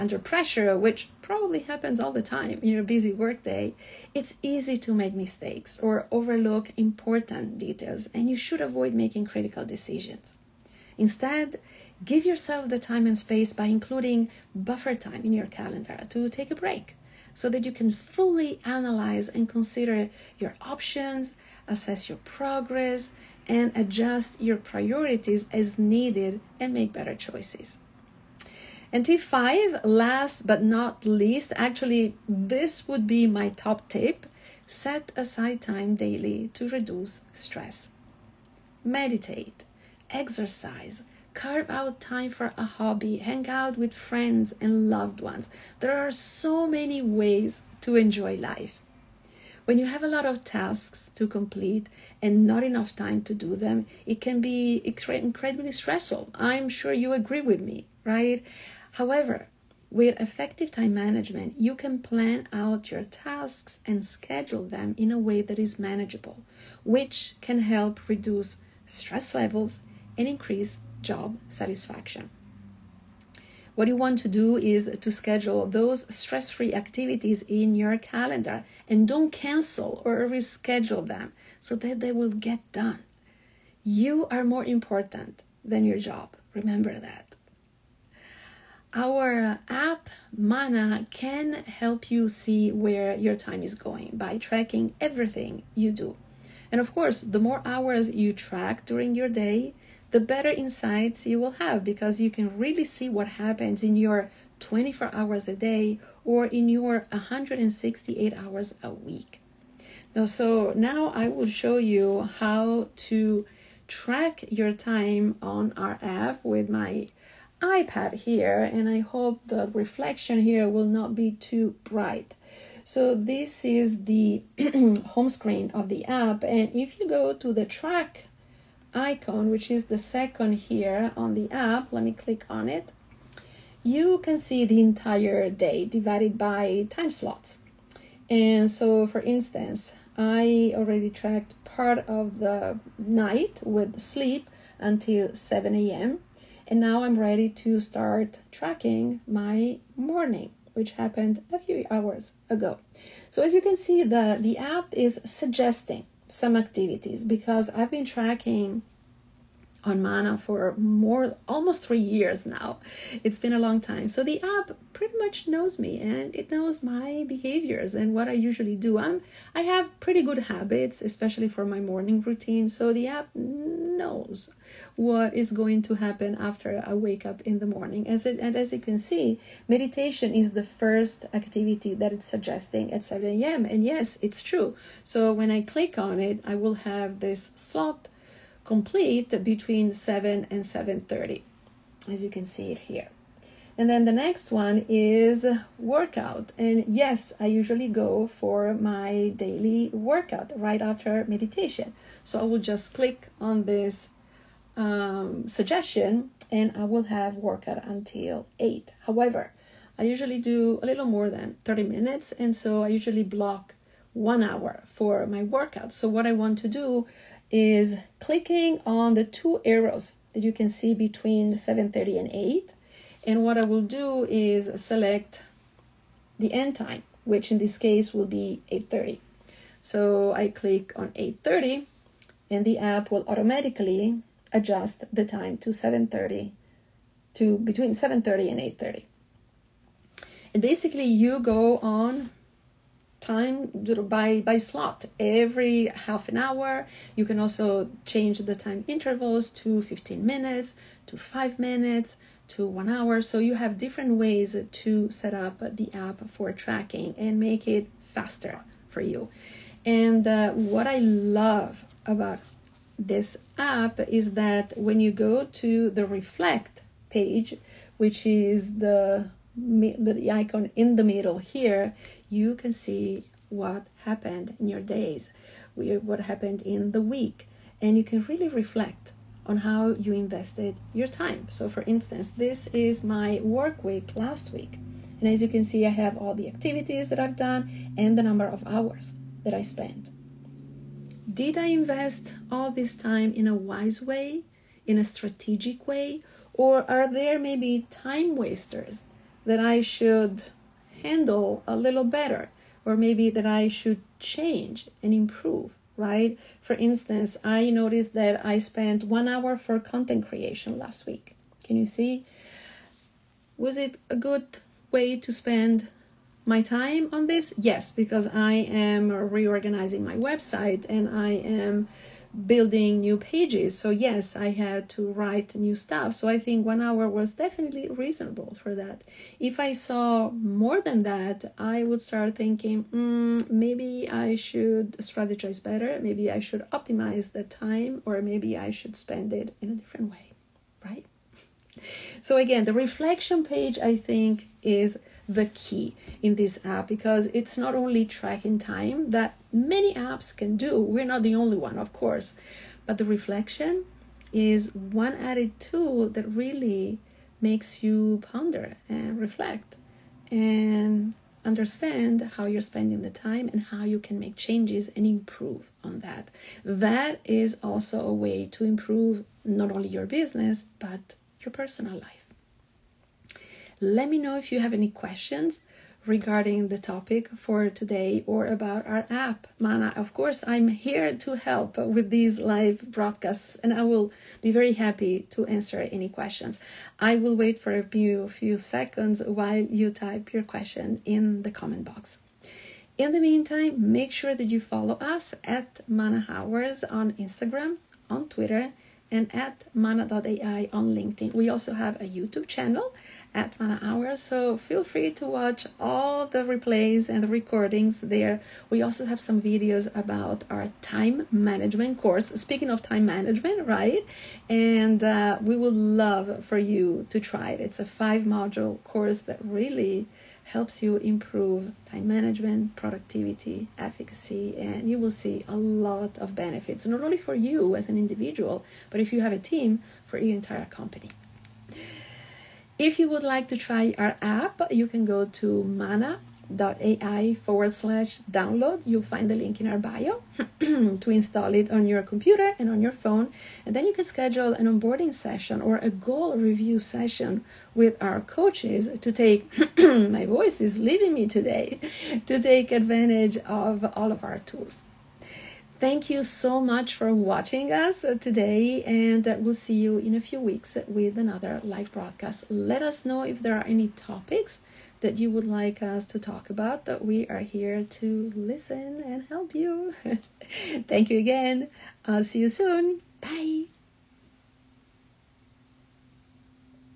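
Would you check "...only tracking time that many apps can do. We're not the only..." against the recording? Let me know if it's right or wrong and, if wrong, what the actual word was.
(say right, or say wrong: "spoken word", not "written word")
right.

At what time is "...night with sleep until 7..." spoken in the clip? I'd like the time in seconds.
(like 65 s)
142 s.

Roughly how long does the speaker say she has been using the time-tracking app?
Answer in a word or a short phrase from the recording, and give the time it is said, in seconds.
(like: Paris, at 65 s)
almost 3 years, at 161 s.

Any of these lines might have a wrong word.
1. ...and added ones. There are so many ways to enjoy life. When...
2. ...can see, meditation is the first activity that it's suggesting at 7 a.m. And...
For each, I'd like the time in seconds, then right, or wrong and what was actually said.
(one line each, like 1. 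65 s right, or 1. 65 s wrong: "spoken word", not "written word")
1. 44 s wrong: "loved", not "added"
2. 178 s right.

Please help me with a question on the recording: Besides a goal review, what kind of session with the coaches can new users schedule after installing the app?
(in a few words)
onboarding session.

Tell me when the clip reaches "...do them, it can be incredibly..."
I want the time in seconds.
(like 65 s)
53 s.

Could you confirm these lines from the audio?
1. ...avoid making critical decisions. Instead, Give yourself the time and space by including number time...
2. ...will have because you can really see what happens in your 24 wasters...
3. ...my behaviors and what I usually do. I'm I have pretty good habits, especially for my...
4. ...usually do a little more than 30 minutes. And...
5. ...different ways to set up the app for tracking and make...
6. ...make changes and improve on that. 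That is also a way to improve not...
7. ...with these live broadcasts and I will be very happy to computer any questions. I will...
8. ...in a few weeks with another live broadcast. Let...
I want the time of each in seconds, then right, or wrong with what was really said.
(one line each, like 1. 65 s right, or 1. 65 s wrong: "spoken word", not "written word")
1. 8 s wrong: "buffer", not "number"
2. 101 s wrong: "hours", not "wasters"
3. 166 s right
4. 210 s right
5. 253 s right
6. 364 s right
7. 381 s wrong: "answer", not "computer"
8. 459 s right.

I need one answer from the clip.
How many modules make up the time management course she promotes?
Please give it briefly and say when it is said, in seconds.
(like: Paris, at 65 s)
5, at 417 s.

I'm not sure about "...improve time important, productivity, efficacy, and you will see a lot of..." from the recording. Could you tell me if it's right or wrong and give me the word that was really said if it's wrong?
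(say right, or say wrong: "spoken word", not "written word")
wrong: "management", not "important".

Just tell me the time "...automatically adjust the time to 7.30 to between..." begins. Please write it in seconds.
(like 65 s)
233 s.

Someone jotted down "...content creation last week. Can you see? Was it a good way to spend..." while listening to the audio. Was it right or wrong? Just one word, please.
right.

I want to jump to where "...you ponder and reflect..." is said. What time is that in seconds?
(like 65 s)
357 s.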